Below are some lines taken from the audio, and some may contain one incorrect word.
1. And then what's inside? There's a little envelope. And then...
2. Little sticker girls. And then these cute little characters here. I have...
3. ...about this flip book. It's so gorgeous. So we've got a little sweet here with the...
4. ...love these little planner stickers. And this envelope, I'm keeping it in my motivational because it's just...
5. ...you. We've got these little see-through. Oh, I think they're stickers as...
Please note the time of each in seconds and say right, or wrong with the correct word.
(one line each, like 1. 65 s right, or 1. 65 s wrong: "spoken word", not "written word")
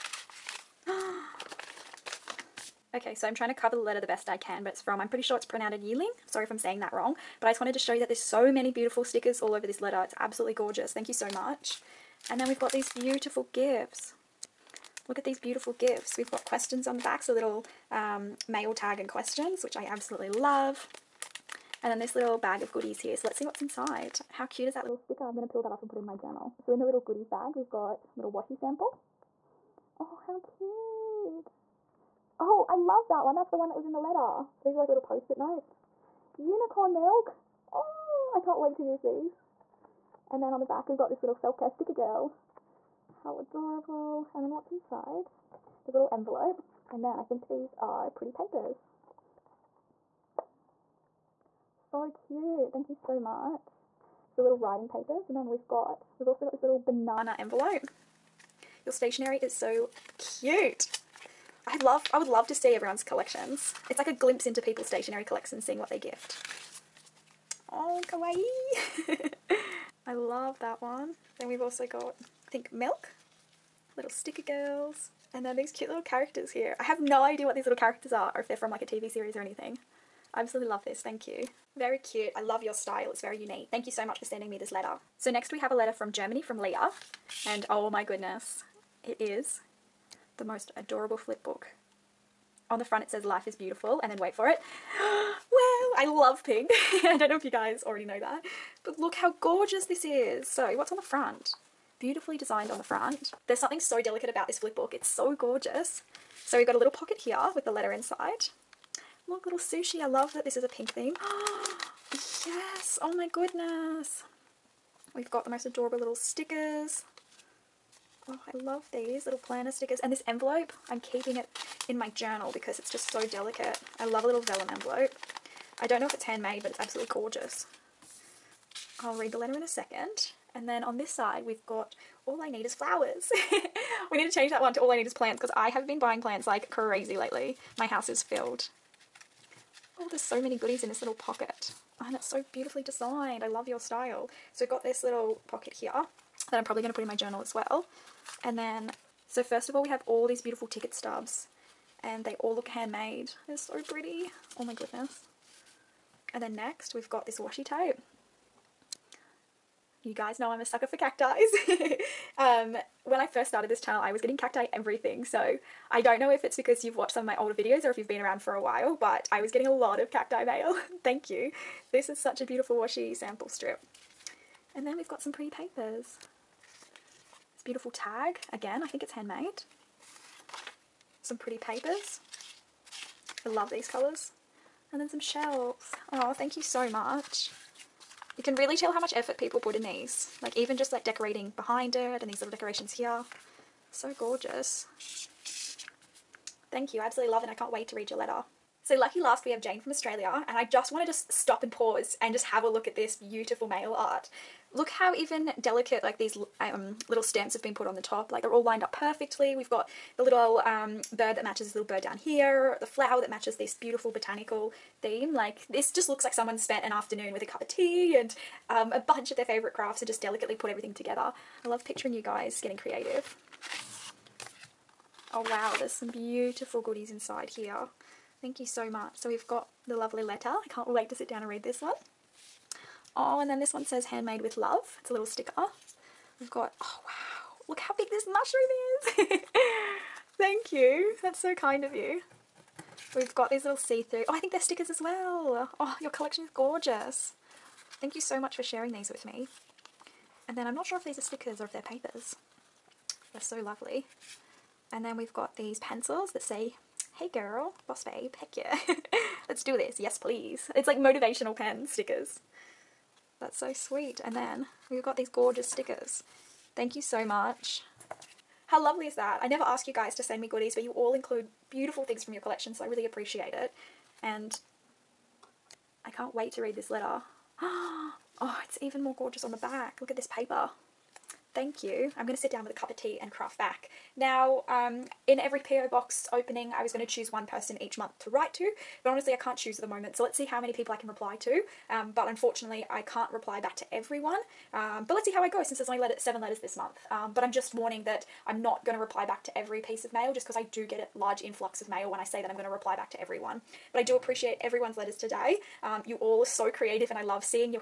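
1. 44 s right
2. 73 s right
3. 104 s wrong: "pocket", not "sweet"
4. 118 s wrong: "journal", not "motivational"
5. 241 s right.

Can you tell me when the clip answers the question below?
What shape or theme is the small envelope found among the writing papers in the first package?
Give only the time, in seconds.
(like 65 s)
56 s.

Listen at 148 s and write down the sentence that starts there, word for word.
And then, so first of all, we have all these beautiful ticket stubs and they all look handmade.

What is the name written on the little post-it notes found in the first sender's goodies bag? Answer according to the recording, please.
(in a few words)
Unicorn milk.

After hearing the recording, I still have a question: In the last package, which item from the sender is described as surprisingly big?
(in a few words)
Mushroom.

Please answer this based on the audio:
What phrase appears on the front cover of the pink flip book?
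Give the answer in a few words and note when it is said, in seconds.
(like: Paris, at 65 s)
Life is beautiful, at 93 s.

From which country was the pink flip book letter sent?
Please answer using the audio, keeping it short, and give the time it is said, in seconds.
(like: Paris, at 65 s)
Germany, at 86 s.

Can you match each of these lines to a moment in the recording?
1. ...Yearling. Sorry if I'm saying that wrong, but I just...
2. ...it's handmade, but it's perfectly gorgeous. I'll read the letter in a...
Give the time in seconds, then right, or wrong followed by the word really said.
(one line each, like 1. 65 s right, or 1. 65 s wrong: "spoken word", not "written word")
1. 5 s right
2. 126 s wrong: "absolutely", not "perfectly".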